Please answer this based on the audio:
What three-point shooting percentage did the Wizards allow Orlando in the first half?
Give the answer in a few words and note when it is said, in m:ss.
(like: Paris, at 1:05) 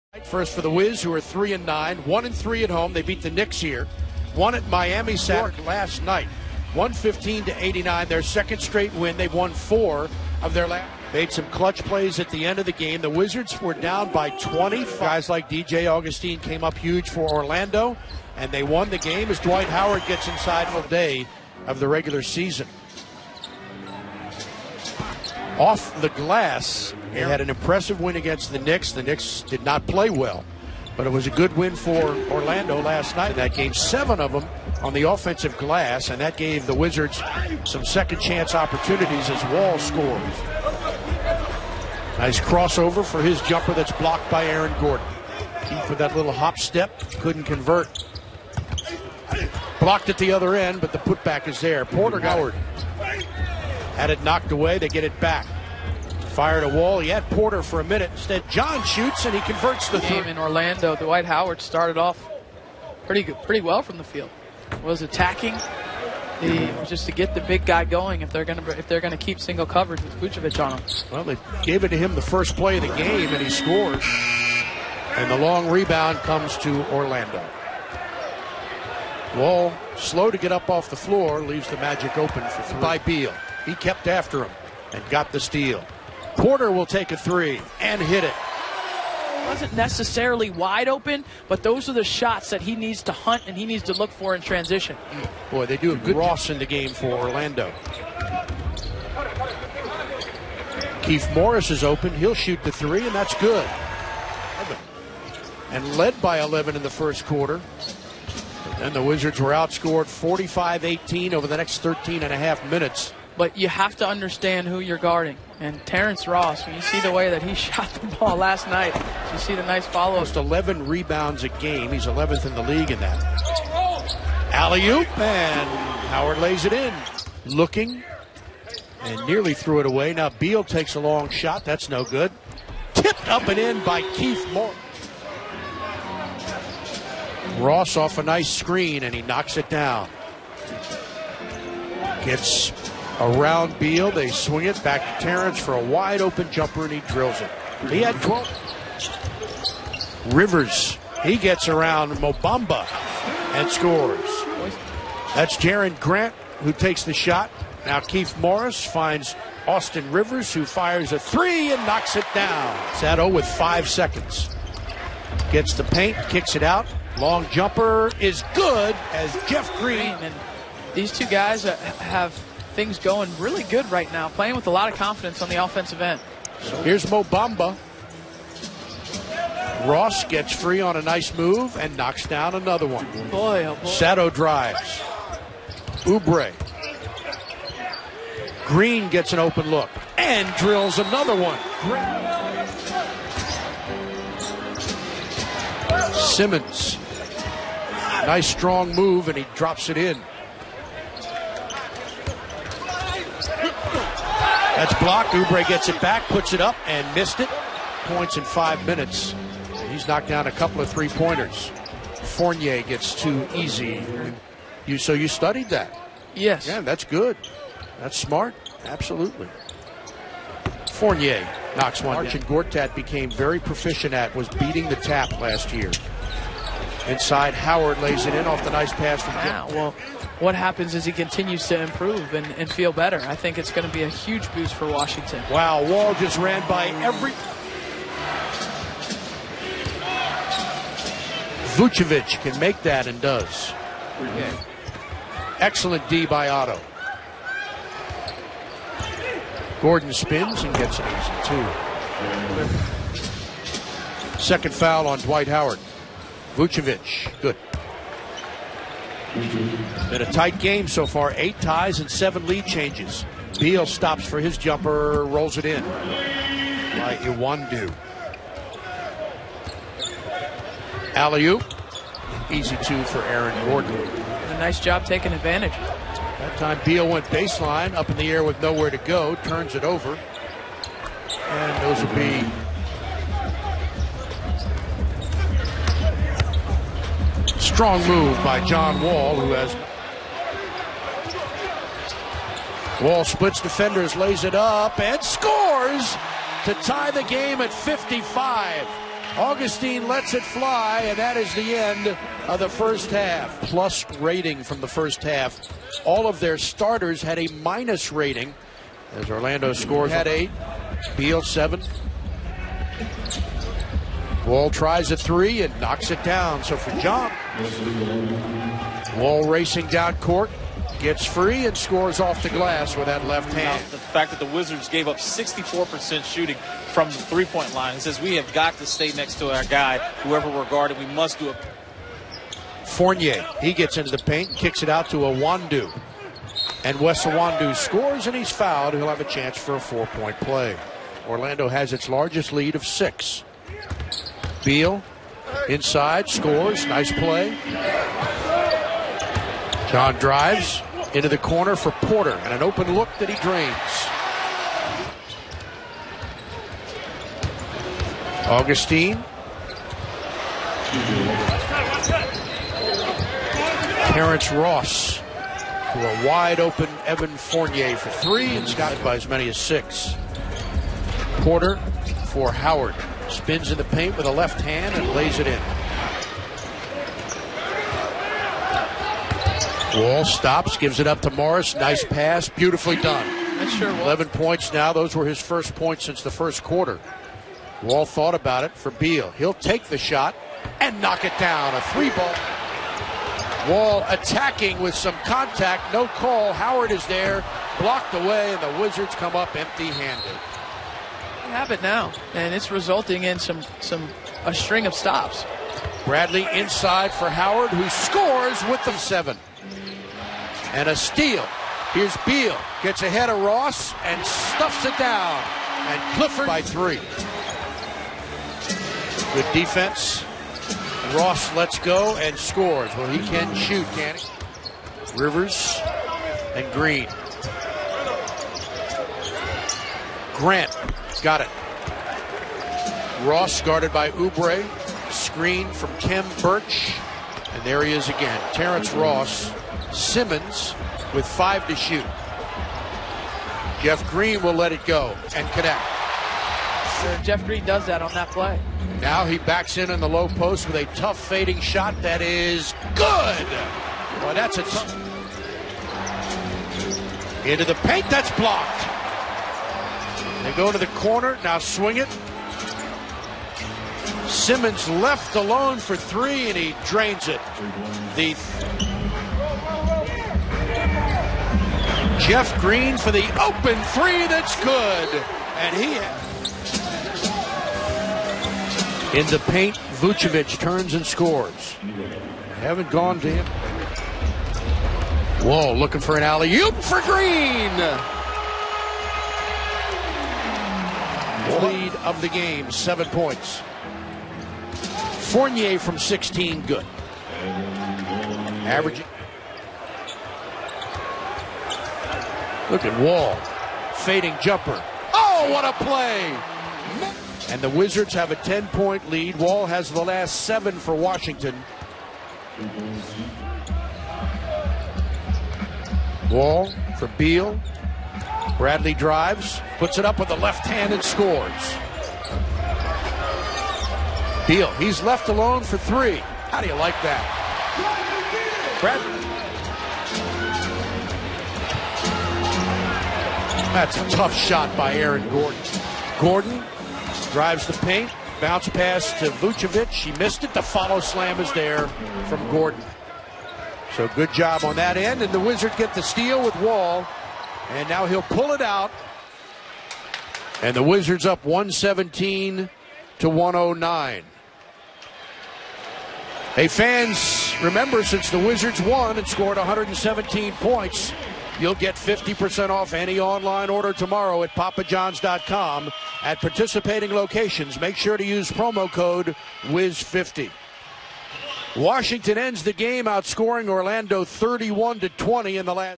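64%, at 5:25.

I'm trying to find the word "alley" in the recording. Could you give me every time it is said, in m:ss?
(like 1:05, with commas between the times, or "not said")
2:04, 4:31, 8:06.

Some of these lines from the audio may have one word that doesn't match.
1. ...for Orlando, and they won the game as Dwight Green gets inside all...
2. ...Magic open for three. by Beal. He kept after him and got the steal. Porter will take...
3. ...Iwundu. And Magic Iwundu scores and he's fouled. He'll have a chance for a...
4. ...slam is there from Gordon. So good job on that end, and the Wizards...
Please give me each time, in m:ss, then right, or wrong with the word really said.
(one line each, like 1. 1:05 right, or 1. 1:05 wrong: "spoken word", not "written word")
1. 0:17 wrong: "Howard", not "Green"
2. 1:21 right
3. 5:35 wrong: "Wesley", not "Magic"
4. 9:00 right.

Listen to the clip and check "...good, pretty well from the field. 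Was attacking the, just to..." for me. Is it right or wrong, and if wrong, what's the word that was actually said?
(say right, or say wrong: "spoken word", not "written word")
right.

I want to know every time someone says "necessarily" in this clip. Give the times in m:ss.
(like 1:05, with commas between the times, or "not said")
1:29.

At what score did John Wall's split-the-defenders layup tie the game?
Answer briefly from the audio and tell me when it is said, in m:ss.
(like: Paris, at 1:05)
55, at 4:57.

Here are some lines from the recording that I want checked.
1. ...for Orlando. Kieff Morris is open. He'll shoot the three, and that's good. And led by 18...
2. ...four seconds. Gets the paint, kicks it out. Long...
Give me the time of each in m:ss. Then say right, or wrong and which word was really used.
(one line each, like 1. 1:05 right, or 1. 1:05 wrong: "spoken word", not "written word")
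1. 1:36 wrong: "11", not "18"
2. 2:43 wrong: "five", not "four".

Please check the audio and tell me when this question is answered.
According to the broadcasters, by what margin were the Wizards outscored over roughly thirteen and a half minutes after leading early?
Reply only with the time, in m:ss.
1:50.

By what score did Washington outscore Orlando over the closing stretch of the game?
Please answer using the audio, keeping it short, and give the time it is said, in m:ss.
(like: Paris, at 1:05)
31 to 20, at 9:34.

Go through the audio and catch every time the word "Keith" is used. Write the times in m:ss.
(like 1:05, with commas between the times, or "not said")
0:45, 2:14.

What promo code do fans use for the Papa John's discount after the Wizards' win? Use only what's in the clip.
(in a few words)
WIZ50.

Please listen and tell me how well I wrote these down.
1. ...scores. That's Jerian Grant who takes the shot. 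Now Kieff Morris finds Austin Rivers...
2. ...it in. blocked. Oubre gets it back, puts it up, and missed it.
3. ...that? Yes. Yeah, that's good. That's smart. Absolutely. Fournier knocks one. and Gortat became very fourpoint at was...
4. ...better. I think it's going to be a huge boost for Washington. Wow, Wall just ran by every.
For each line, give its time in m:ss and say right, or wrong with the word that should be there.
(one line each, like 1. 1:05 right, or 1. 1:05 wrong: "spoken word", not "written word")
1. 2:33 right
2. 3:19 right
3. 3:35 wrong: "proficient", not "fourpoint"
4. 3:52 right.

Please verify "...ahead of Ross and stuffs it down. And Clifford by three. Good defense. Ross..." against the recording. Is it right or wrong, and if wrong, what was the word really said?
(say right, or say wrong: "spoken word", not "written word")
right.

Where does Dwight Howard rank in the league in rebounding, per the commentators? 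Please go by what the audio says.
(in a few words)
11th.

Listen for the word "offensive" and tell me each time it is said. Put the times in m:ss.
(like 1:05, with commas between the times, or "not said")
0:35, 2:55.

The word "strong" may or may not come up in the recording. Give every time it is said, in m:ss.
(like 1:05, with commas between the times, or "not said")
3:18, 4:47.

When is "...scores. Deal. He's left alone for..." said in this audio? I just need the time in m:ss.
8:41.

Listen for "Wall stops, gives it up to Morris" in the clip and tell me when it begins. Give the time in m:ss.
6:20.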